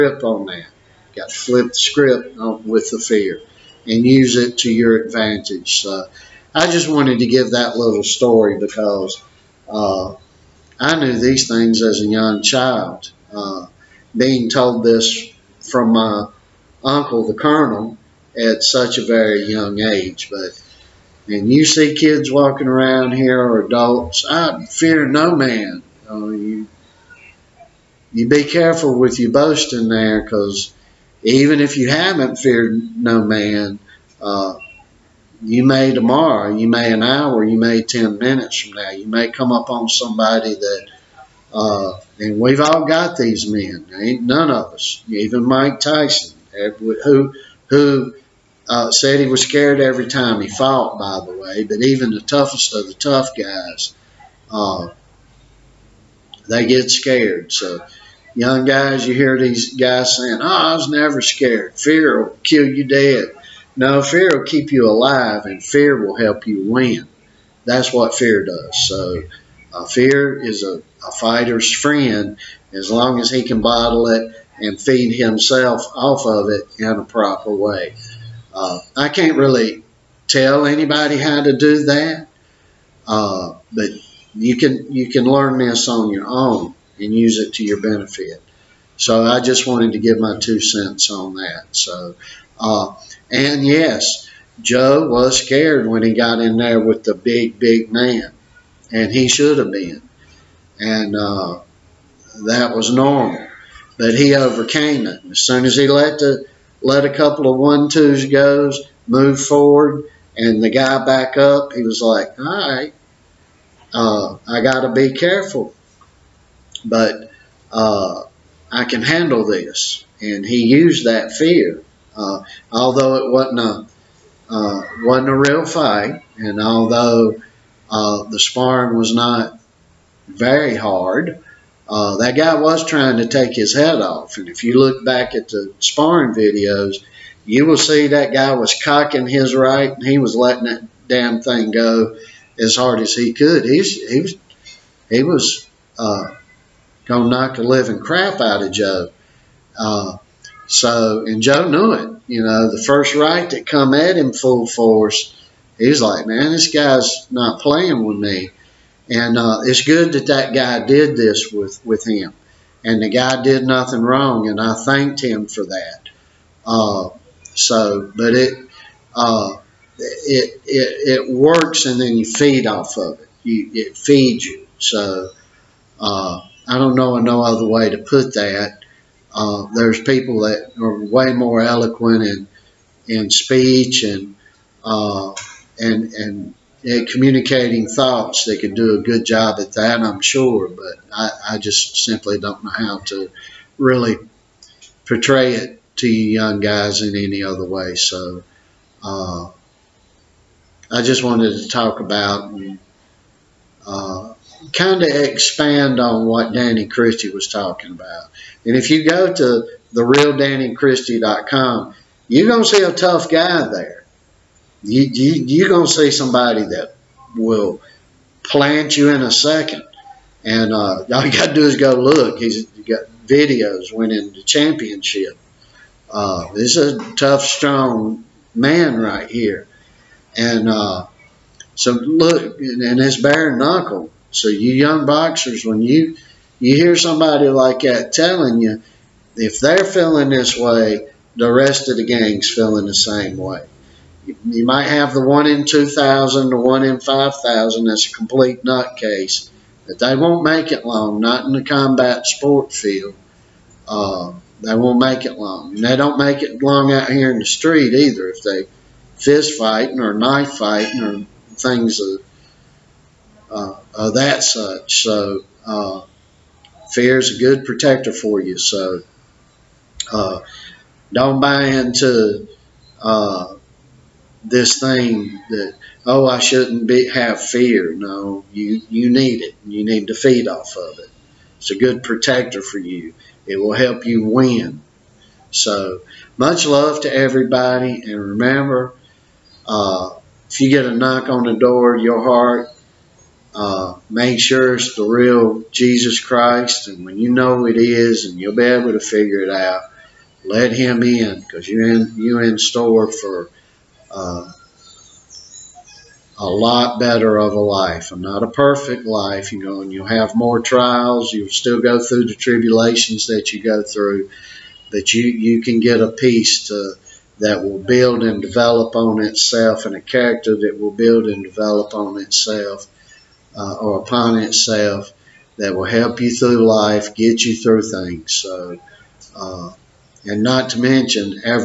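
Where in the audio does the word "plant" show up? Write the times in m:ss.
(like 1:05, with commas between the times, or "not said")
3:38.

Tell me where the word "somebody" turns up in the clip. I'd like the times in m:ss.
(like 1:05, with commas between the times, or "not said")
0:39, 3:36, 3:56.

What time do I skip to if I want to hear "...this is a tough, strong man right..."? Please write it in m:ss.
3:46.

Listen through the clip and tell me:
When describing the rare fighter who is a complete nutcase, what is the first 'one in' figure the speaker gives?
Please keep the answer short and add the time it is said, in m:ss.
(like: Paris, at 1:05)
1 in 2,000, at 4:05.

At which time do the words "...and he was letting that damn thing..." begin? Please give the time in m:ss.
2:19.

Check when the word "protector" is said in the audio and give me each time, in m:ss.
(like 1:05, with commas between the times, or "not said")
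4:27, 4:42.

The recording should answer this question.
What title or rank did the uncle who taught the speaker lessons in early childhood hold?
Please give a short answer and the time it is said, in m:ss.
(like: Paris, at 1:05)
Colonel, at 0:17.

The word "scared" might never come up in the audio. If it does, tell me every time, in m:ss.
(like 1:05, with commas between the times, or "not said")
0:49, 0:56, 1:01, 1:35.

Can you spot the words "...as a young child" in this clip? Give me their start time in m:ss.
0:11.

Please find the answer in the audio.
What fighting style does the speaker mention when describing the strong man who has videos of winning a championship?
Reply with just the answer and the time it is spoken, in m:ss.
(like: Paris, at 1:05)
Bare knuckle, at 3:53.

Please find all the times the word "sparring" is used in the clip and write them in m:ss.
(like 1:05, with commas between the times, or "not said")
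2:08, 2:15.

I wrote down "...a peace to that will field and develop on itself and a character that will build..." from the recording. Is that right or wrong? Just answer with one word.
wrong.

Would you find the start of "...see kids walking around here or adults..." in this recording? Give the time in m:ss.
0:21.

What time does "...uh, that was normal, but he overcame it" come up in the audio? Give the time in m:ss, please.
1:41.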